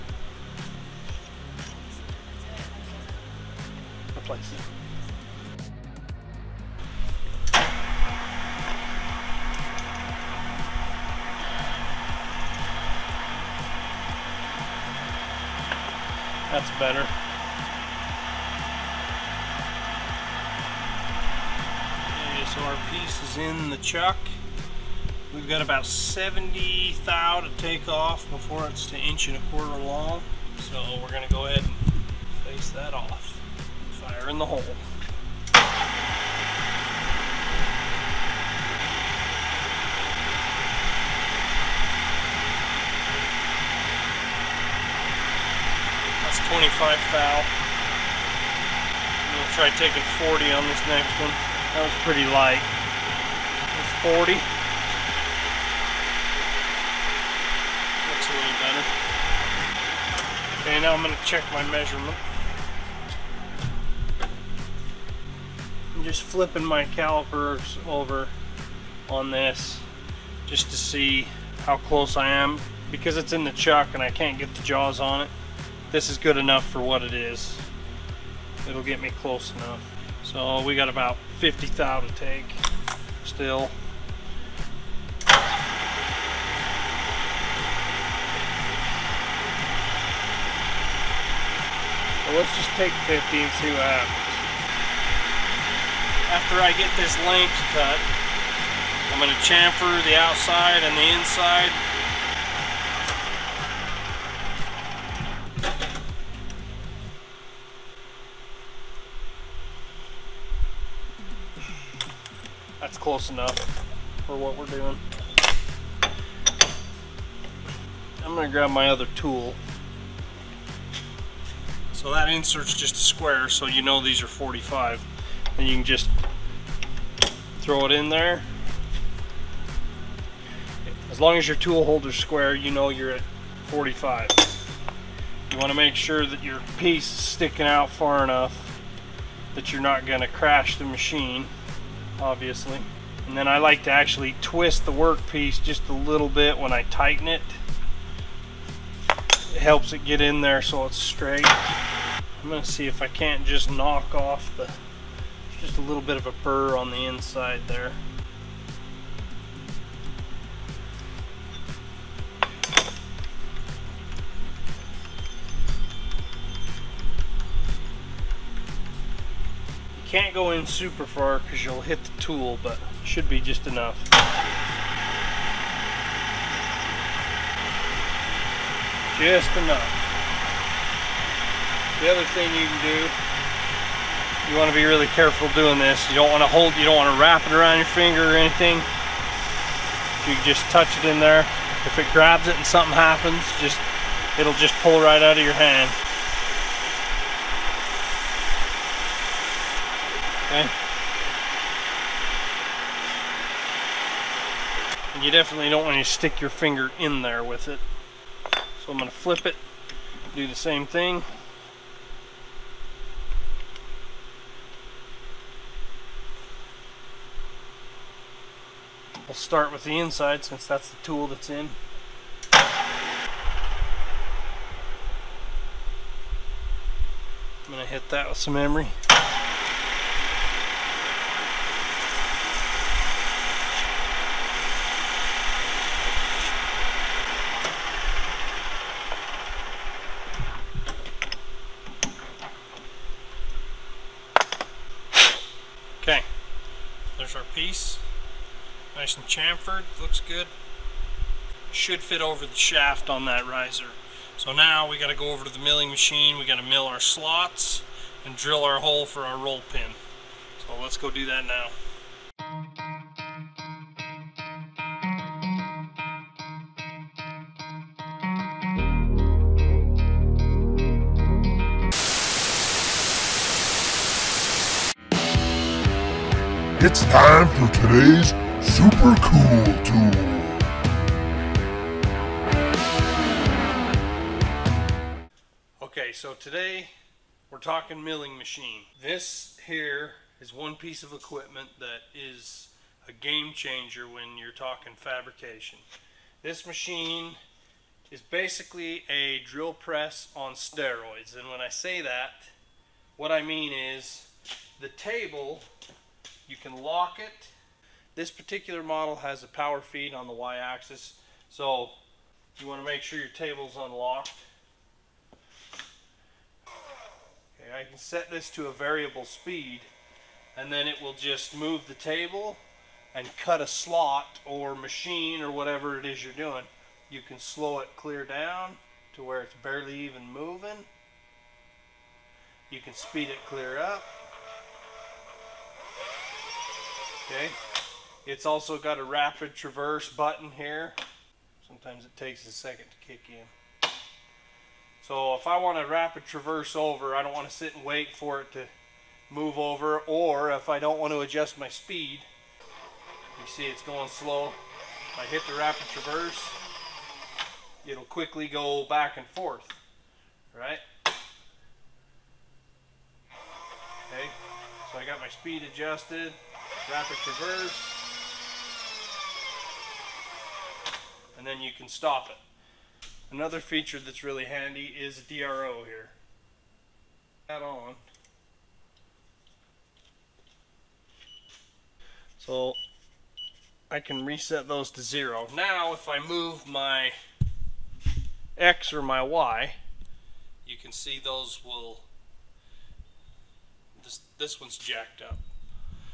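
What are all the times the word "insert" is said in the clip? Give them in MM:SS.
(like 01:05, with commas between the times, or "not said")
02:02.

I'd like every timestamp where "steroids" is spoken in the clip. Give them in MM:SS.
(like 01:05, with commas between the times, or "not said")
05:00.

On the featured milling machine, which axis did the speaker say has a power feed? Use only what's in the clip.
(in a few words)
Y-axis.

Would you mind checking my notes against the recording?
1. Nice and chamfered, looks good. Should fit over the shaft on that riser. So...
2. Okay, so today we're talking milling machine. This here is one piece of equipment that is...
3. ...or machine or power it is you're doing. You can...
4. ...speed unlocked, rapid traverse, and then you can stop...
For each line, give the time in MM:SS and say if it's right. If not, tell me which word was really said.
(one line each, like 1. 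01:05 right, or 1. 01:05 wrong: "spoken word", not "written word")
1. 04:08 right
2. 04:45 right
3. 05:24 wrong: "whatever", not "power"
4. 06:05 wrong: "adjusted", not "unlocked".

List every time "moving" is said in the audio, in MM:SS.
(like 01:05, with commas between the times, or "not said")
05:30.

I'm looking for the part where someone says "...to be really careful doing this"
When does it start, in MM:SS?
03:04.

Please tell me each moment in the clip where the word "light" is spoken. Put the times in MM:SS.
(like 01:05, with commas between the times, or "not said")
00:52.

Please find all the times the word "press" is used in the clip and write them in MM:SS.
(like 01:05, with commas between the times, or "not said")
04:59.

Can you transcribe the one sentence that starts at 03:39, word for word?
We'll start with the inside since that's the tool that's in.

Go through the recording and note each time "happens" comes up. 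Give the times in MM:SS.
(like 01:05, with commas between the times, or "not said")
01:33, 03:12.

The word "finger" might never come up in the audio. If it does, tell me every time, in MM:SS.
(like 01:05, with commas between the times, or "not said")
03:07, 03:26.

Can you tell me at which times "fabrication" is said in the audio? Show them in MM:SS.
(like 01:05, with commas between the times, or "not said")
04:54.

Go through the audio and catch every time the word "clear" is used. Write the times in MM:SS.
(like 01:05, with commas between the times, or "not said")
05:27, 05:33.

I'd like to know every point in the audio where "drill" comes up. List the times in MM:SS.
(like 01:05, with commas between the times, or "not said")
04:18, 04:59.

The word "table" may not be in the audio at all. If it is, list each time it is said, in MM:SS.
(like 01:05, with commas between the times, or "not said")
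05:04, 05:13, 05:21.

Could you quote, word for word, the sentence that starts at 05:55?
If I hit the rapid traverse, it'll quickly go back and forth, right?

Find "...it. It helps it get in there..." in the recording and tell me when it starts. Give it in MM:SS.
02:27.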